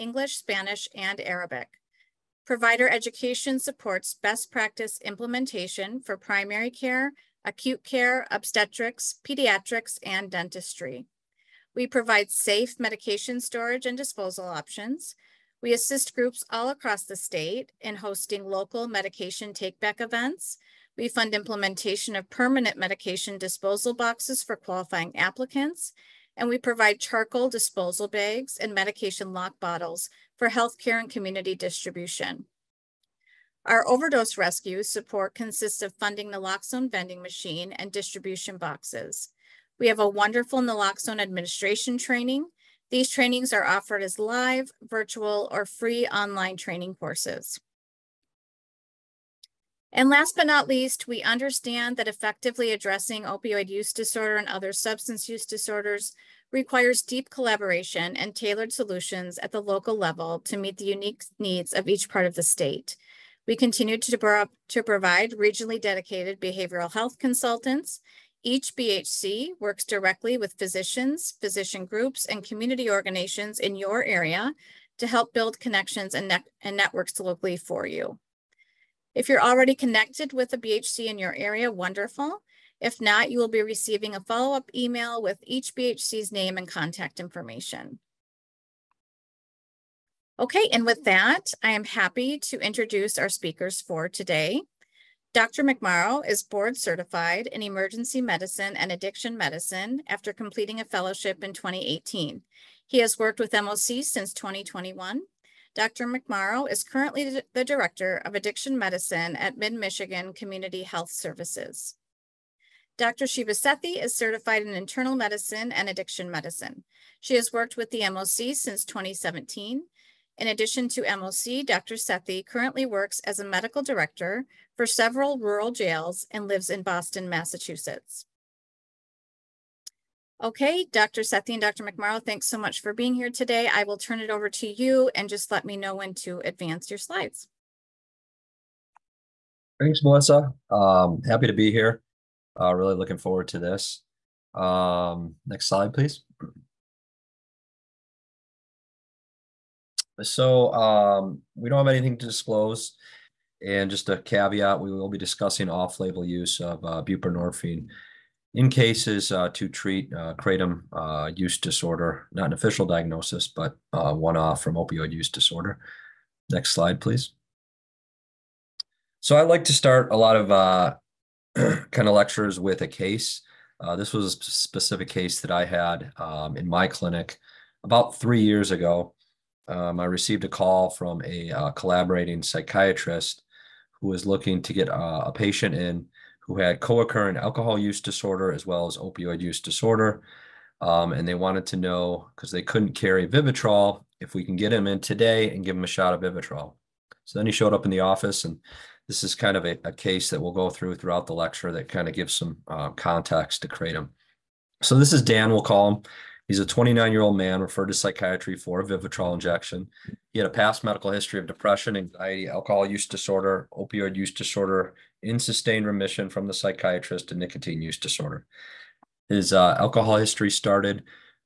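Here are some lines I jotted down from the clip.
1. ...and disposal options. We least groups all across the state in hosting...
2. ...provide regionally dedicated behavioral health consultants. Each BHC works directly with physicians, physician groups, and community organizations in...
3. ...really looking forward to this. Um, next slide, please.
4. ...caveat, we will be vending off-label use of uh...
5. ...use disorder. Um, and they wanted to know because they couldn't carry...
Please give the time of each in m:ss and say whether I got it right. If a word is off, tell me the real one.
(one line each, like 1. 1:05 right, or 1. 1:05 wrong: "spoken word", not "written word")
1. 0:13 wrong: "assist", not "least"
2. 1:04 right
3. 2:22 right
4. 2:34 wrong: "discussing", not "vending"
5. 3:09 right.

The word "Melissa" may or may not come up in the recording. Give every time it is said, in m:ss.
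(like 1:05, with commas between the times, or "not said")
2:20.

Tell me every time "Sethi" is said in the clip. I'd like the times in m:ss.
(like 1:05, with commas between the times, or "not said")
1:53, 2:01, 2:11.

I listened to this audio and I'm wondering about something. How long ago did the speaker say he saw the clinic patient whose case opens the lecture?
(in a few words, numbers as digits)
3 years.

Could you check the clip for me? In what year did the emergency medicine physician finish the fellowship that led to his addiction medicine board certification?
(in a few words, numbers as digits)
2018.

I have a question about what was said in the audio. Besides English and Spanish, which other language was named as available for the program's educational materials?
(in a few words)
Arabic.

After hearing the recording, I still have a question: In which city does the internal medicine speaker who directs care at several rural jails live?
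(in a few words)
Boston.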